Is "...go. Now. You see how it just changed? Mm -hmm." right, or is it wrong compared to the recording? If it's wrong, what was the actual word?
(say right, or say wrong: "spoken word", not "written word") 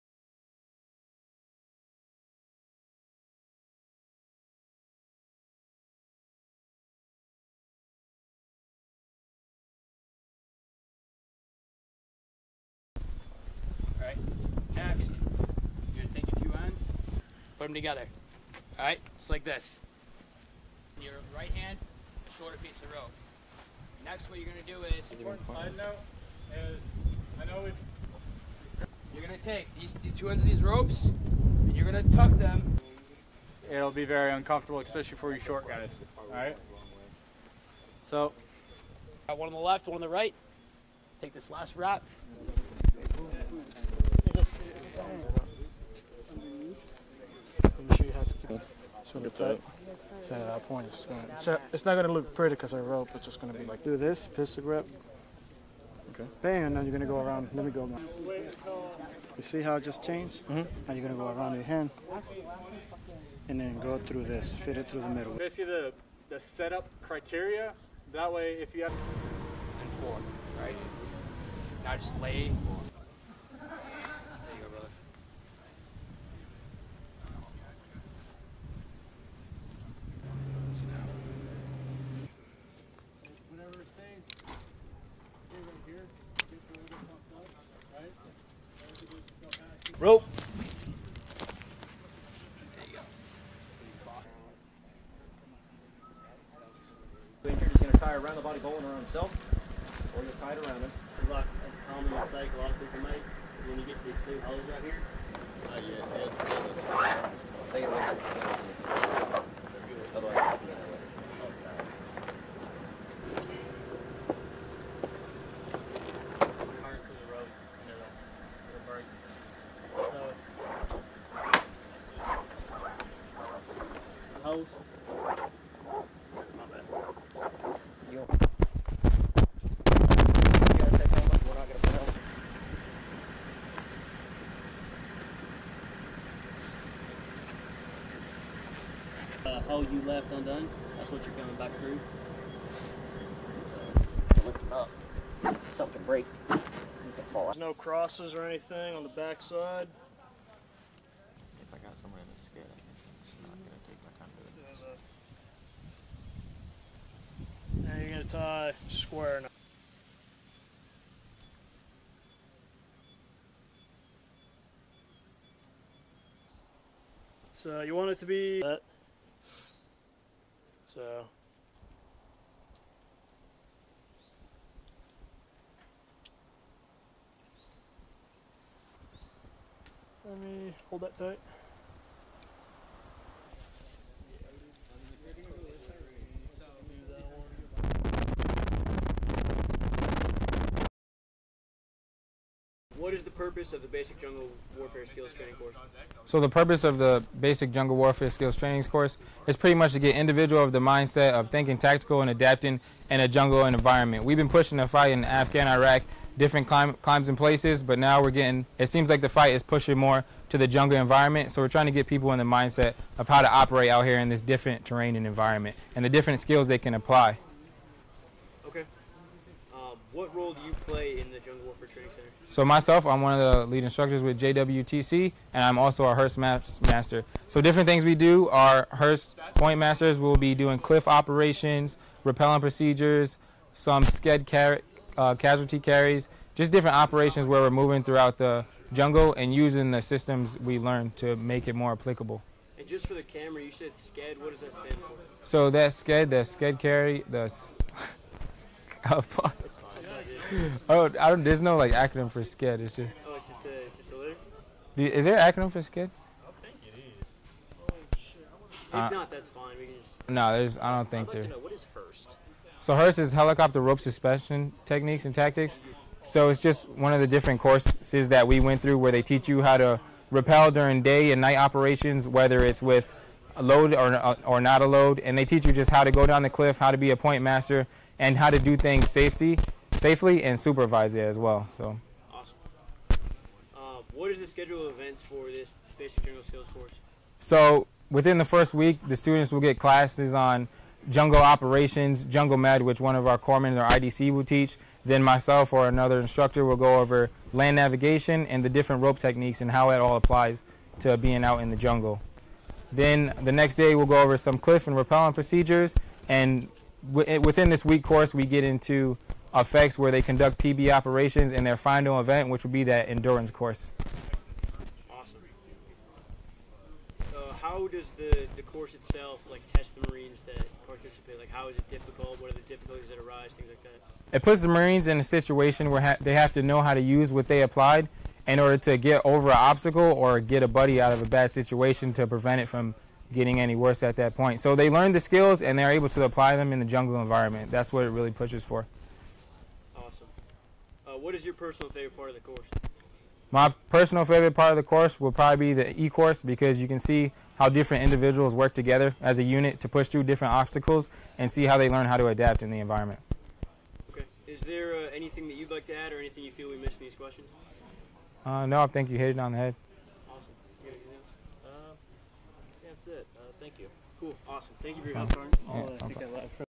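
right.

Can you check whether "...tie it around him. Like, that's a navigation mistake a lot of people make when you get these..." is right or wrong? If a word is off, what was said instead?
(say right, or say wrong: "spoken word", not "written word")
wrong: "common", not "navigation".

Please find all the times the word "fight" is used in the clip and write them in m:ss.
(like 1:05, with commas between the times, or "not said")
3:24, 3:29.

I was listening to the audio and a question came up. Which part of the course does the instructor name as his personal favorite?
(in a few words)
The e-course.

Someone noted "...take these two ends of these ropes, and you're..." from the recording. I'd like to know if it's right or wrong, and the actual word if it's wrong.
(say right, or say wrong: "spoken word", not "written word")
right.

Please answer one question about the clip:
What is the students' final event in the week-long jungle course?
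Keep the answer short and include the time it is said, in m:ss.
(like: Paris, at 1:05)
Endurance course, at 5:13.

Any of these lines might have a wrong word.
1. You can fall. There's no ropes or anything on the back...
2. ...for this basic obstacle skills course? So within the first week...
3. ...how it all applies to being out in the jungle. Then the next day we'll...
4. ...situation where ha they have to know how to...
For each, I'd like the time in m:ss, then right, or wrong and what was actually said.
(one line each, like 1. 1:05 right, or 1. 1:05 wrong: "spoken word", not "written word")
1. 2:26 wrong: "crosses", not "ropes"
2. 4:45 wrong: "jungle", not "obstacle"
3. 4:59 right
4. 5:25 right.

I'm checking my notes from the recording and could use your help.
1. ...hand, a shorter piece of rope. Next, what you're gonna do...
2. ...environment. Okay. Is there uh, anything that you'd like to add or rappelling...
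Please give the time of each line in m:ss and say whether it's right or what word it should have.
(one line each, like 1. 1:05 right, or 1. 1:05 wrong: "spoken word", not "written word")
1. 0:21 right
2. 5:52 wrong: "anything", not "rappelling".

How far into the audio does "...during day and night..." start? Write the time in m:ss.
4:30.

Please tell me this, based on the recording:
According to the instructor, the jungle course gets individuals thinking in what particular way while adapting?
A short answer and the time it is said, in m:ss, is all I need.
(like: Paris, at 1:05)
Tactical, at 3:21.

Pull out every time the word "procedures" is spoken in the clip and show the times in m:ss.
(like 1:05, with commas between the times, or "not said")
3:52, 5:05.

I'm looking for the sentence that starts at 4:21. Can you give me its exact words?
Know, what is So HRST is helicopter rope suspension techniques and tactics.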